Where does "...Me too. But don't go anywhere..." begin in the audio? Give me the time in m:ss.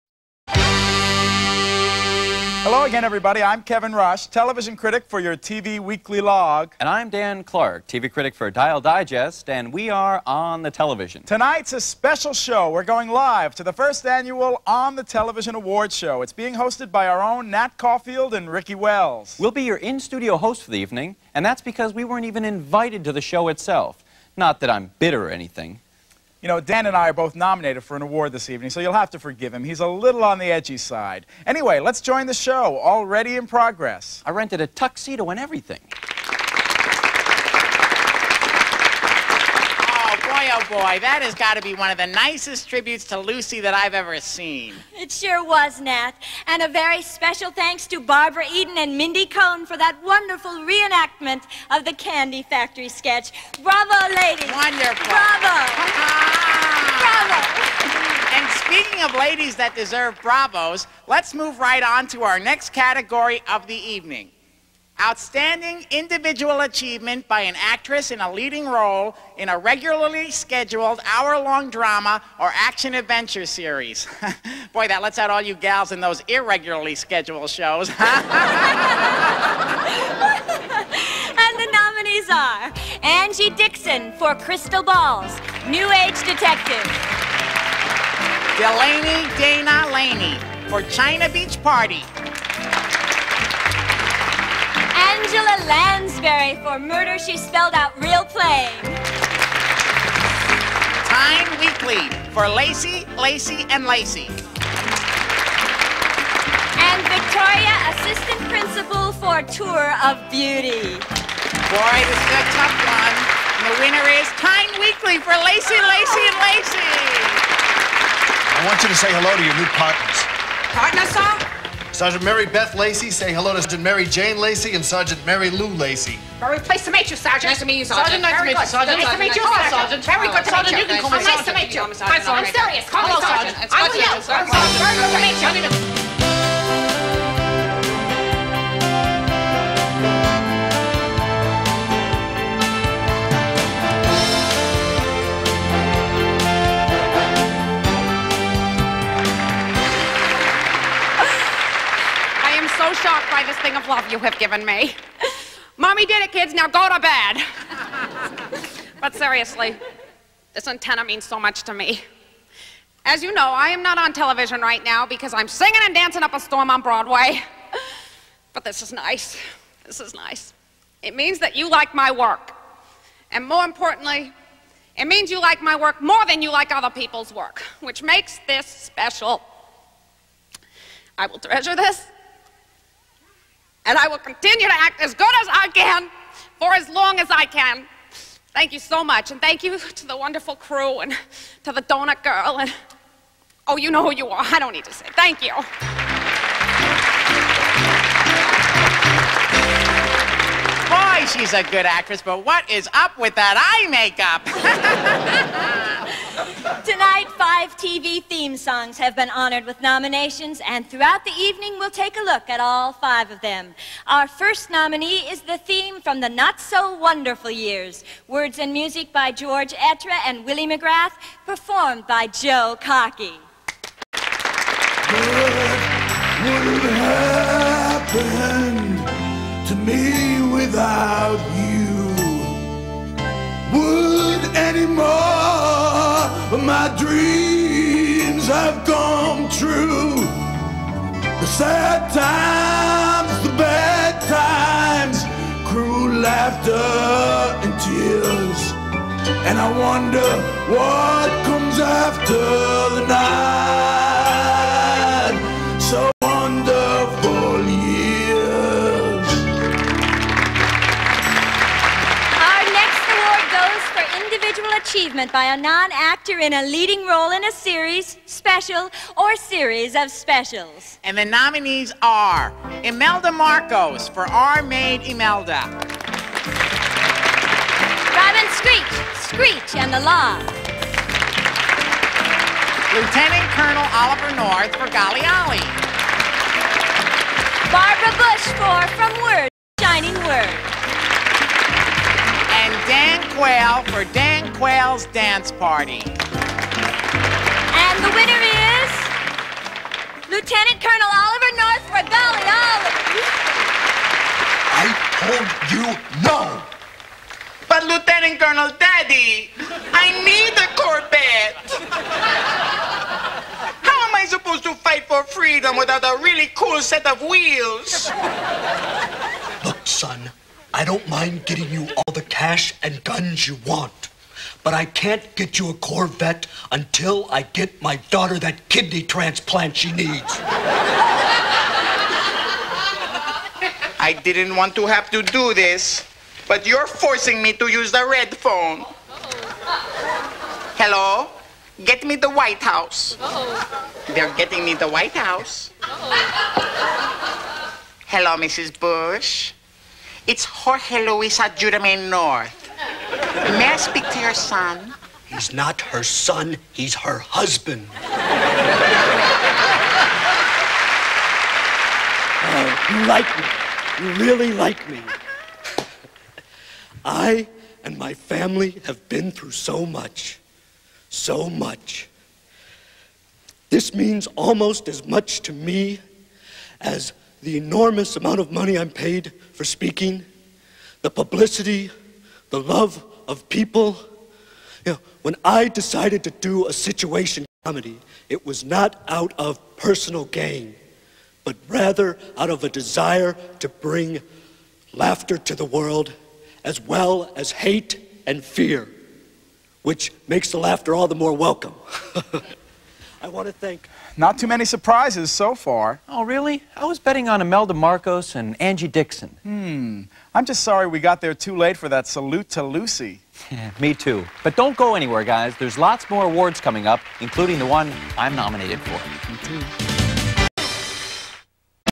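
6:53.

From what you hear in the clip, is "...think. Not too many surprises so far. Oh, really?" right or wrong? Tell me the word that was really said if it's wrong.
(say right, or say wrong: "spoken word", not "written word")
right.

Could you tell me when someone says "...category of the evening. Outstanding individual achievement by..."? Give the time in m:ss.
1:02.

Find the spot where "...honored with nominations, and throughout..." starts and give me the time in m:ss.
3:29.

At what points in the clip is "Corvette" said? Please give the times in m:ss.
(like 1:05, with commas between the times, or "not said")
5:10, 5:25.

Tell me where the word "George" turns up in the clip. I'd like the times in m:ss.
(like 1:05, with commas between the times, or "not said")
3:39.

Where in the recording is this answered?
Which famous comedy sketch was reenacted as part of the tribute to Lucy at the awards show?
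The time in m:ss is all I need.
0:51.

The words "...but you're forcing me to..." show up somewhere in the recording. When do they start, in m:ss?
5:36.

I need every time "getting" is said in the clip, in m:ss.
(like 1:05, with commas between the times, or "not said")
5:21, 5:44.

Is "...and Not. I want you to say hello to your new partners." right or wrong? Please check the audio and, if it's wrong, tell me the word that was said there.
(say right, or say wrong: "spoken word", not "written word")
wrong: "Lacey", not "Not".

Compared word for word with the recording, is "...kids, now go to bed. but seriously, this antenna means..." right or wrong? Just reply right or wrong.
right.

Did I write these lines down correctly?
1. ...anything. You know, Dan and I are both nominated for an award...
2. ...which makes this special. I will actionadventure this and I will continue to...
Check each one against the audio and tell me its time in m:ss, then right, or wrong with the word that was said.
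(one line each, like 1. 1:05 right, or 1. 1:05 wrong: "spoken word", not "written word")
1. 0:25 right
2. 2:57 wrong: "treasure", not "actionadventure".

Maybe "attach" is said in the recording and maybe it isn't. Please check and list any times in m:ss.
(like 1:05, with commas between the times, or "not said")
not said.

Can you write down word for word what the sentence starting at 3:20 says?
Boy, she's a good actress, but what is up with that eye makeup?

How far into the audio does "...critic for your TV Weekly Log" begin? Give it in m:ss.
0:04.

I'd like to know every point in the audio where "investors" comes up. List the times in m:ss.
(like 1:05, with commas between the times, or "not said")
not said.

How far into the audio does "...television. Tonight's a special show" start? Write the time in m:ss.
0:10.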